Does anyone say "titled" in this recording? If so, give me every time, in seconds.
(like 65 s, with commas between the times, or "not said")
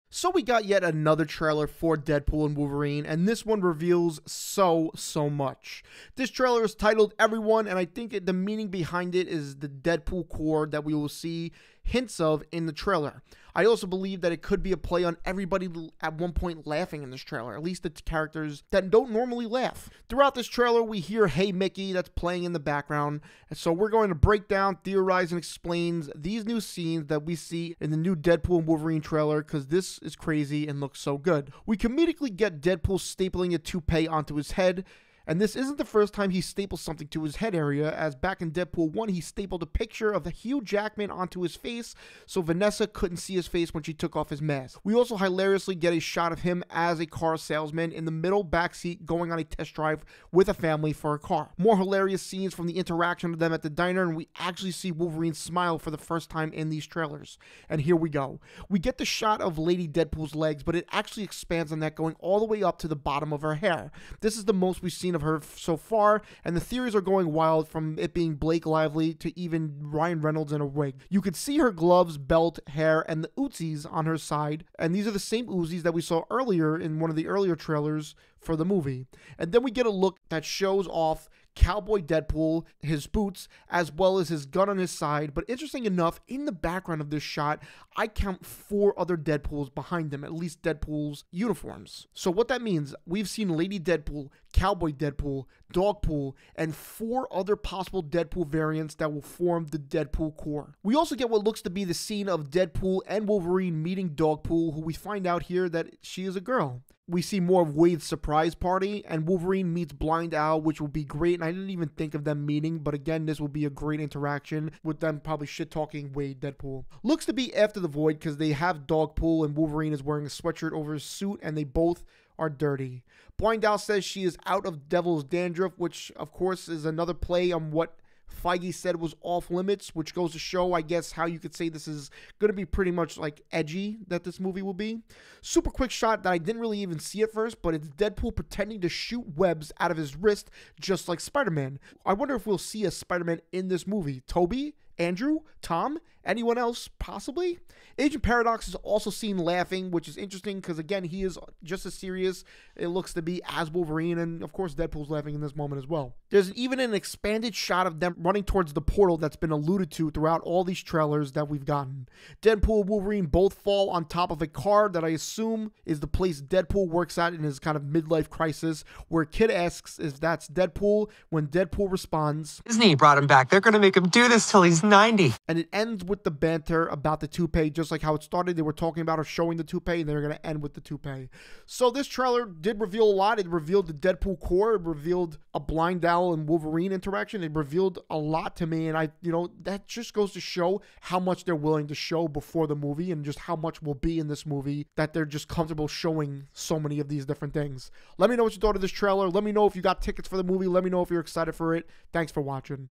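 6 s.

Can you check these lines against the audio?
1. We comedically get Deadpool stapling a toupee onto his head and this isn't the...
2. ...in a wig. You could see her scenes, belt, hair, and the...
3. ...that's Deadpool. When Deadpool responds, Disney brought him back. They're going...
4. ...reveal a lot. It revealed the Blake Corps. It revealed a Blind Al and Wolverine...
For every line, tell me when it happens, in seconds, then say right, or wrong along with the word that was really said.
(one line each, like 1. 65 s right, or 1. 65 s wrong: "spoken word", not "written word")
1. 31 s right
2. 70 s wrong: "gloves", not "scenes"
3. 170 s right
4. 182 s wrong: "Deadpool", not "Blake".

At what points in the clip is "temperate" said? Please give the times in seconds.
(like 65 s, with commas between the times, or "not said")
not said.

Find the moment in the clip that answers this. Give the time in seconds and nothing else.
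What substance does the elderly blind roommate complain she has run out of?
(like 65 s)
124 s.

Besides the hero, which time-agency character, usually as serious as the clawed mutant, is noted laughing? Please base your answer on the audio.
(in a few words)
Agent Paradox.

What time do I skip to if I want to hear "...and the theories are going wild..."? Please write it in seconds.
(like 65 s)
66 s.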